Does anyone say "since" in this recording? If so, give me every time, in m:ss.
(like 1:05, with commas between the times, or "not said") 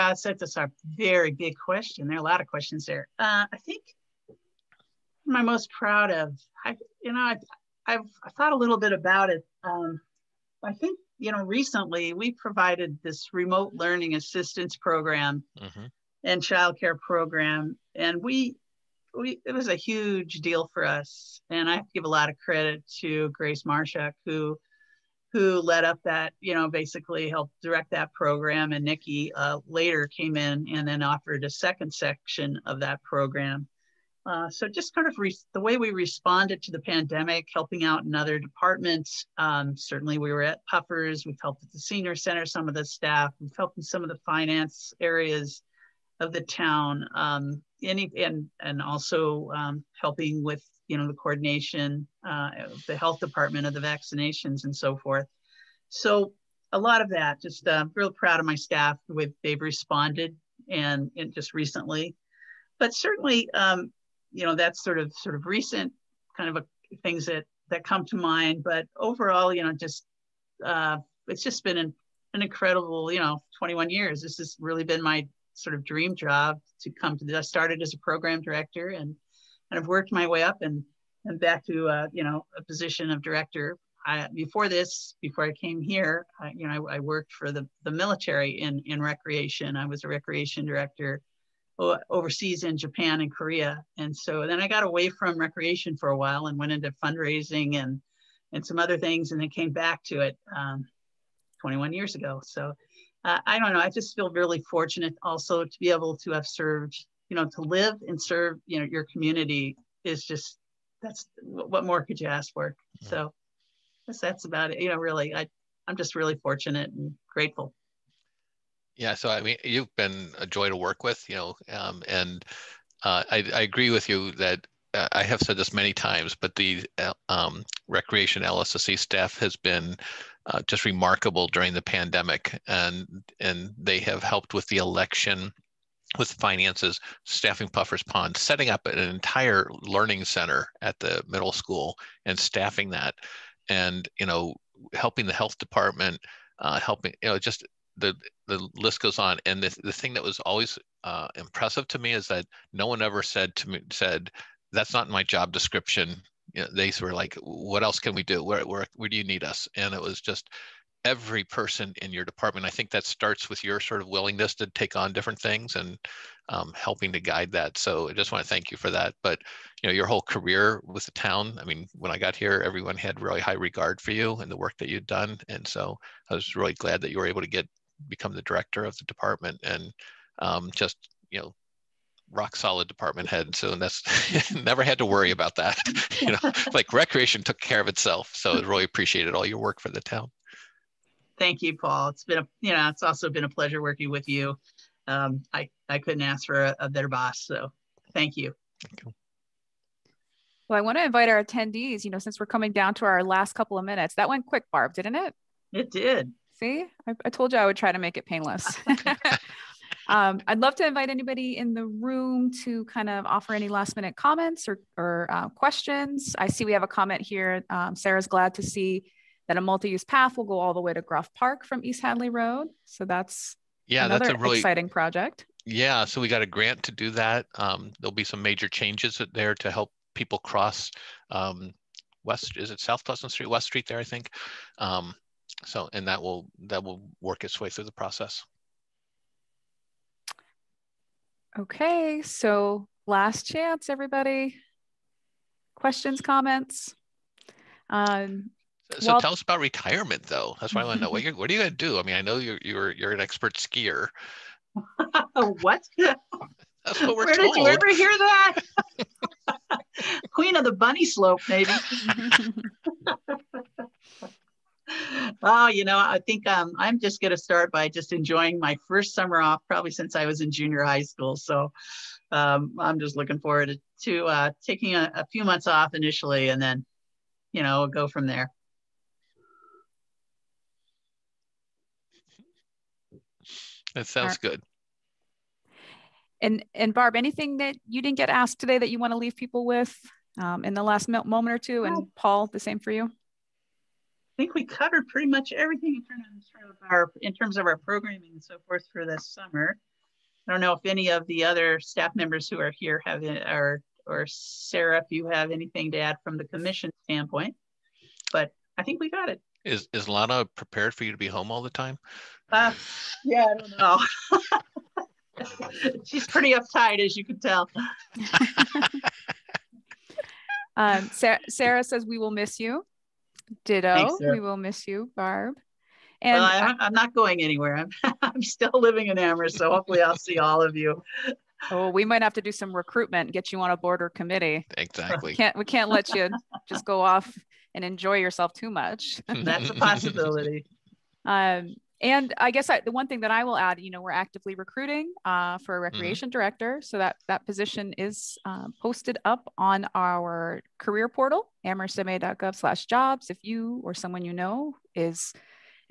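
3:22, 4:29.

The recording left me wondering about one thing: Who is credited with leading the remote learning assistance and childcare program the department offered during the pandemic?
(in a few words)
Grace Marshak.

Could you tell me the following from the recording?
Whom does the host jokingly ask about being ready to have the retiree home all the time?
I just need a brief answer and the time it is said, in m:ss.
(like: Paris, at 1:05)
Lana, at 5:10.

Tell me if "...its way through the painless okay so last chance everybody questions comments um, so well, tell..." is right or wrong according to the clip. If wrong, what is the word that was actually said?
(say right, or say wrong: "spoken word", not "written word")
wrong: "process", not "painless".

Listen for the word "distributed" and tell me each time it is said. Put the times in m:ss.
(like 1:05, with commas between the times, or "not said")
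not said.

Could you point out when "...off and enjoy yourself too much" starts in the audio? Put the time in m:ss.
5:37.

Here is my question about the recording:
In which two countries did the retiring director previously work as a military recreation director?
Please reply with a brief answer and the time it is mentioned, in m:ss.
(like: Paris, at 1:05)
Japan and Korea, at 1:32.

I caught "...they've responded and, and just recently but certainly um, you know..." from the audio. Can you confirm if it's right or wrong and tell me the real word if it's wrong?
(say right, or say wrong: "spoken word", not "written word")
right.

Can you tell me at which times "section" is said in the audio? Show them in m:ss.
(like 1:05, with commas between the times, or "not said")
0:31.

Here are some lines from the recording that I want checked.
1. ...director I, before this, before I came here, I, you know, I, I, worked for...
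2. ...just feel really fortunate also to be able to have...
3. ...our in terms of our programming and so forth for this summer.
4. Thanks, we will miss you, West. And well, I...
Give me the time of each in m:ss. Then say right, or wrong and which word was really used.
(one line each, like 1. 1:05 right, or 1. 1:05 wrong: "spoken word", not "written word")
1. 1:23 right
2. 1:43 right
3. 4:56 right
4. 5:23 wrong: "Barb", not "West".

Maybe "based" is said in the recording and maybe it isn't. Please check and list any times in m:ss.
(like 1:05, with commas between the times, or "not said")
not said.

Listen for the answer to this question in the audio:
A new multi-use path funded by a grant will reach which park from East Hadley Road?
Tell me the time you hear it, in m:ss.
3:41.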